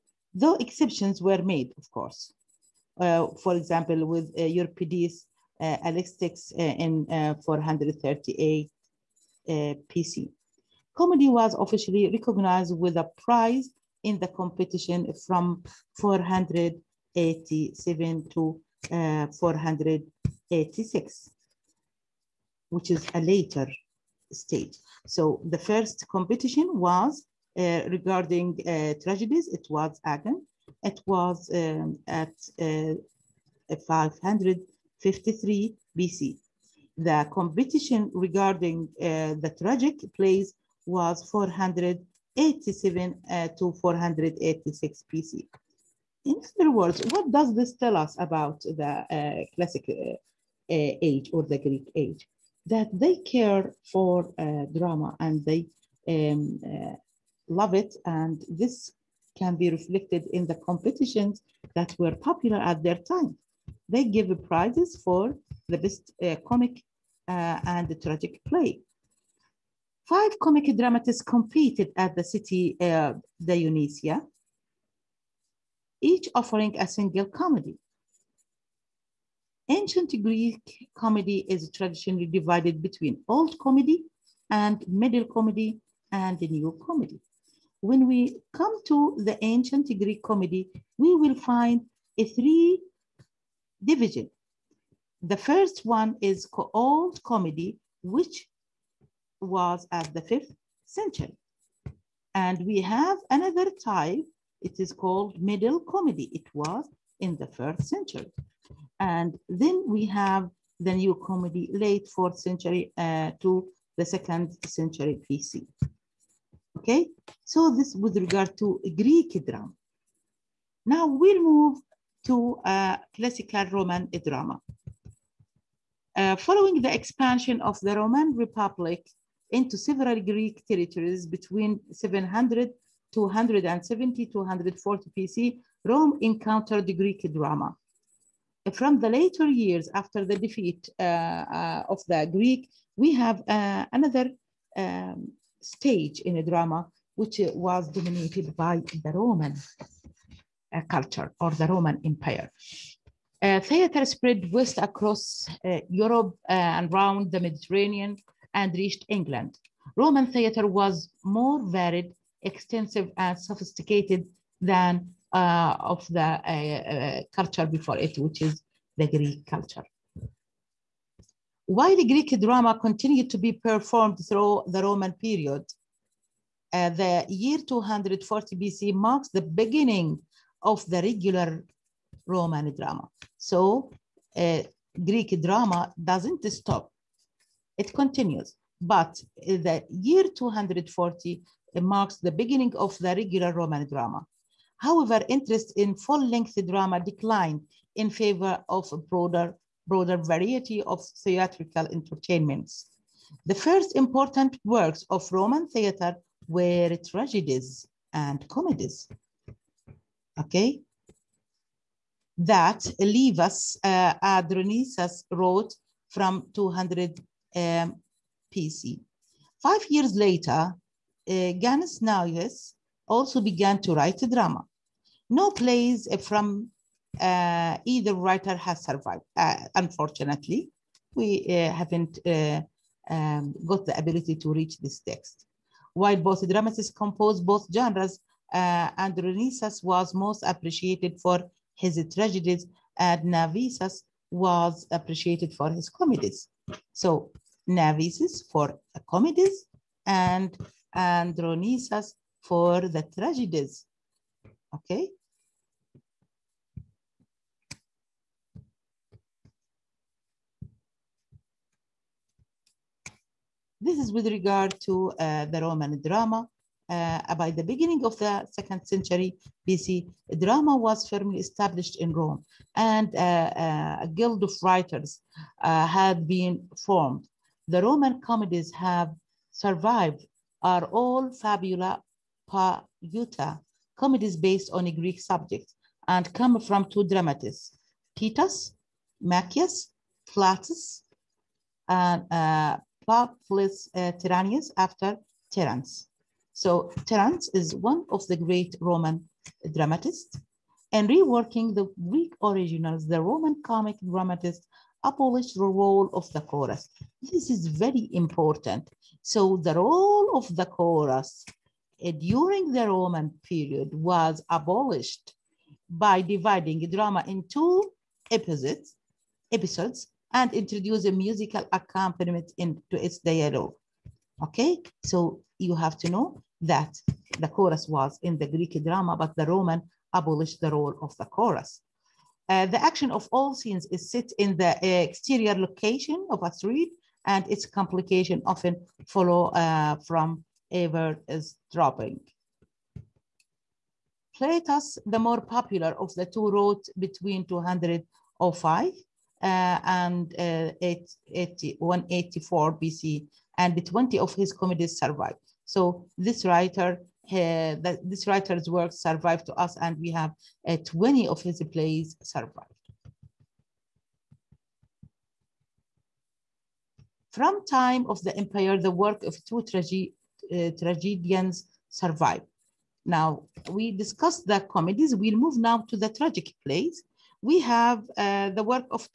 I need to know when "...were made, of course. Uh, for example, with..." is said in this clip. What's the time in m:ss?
0:01.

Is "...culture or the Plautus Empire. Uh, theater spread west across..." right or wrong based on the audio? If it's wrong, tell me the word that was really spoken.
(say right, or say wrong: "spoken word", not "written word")
wrong: "Roman", not "Plautus".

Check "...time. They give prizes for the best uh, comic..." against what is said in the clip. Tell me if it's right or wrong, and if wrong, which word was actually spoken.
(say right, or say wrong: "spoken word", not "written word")
right.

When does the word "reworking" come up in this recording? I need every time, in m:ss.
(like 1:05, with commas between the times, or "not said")
5:01.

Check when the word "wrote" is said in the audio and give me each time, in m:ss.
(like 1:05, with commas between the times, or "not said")
3:35, 5:46.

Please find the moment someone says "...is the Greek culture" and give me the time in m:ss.
2:48.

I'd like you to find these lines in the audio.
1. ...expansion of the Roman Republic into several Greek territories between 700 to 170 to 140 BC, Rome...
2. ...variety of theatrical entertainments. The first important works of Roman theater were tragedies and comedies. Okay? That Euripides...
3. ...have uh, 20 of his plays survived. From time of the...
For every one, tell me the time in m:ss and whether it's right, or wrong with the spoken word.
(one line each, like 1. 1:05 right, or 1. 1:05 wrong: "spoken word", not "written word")
1. 2:06 right
2. 3:20 wrong: "Livius", not "Euripides"
3. 6:00 right.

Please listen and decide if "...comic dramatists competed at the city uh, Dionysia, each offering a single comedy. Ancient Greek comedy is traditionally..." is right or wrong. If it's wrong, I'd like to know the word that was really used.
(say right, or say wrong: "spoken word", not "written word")
right.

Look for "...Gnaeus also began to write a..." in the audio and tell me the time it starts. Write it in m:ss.
3:41.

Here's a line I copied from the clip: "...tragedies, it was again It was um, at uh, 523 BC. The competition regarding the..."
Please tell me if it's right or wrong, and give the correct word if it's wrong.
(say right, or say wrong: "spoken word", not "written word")
wrong: "553", not "523".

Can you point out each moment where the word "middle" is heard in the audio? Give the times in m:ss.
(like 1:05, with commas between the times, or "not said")
1:24, 1:45.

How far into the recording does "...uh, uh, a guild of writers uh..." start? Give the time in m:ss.
4:33.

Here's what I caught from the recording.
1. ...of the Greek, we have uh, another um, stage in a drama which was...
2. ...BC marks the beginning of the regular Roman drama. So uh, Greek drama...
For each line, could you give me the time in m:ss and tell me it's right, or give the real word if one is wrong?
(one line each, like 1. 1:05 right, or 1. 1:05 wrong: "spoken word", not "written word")
1. 2:21 right
2. 2:58 right.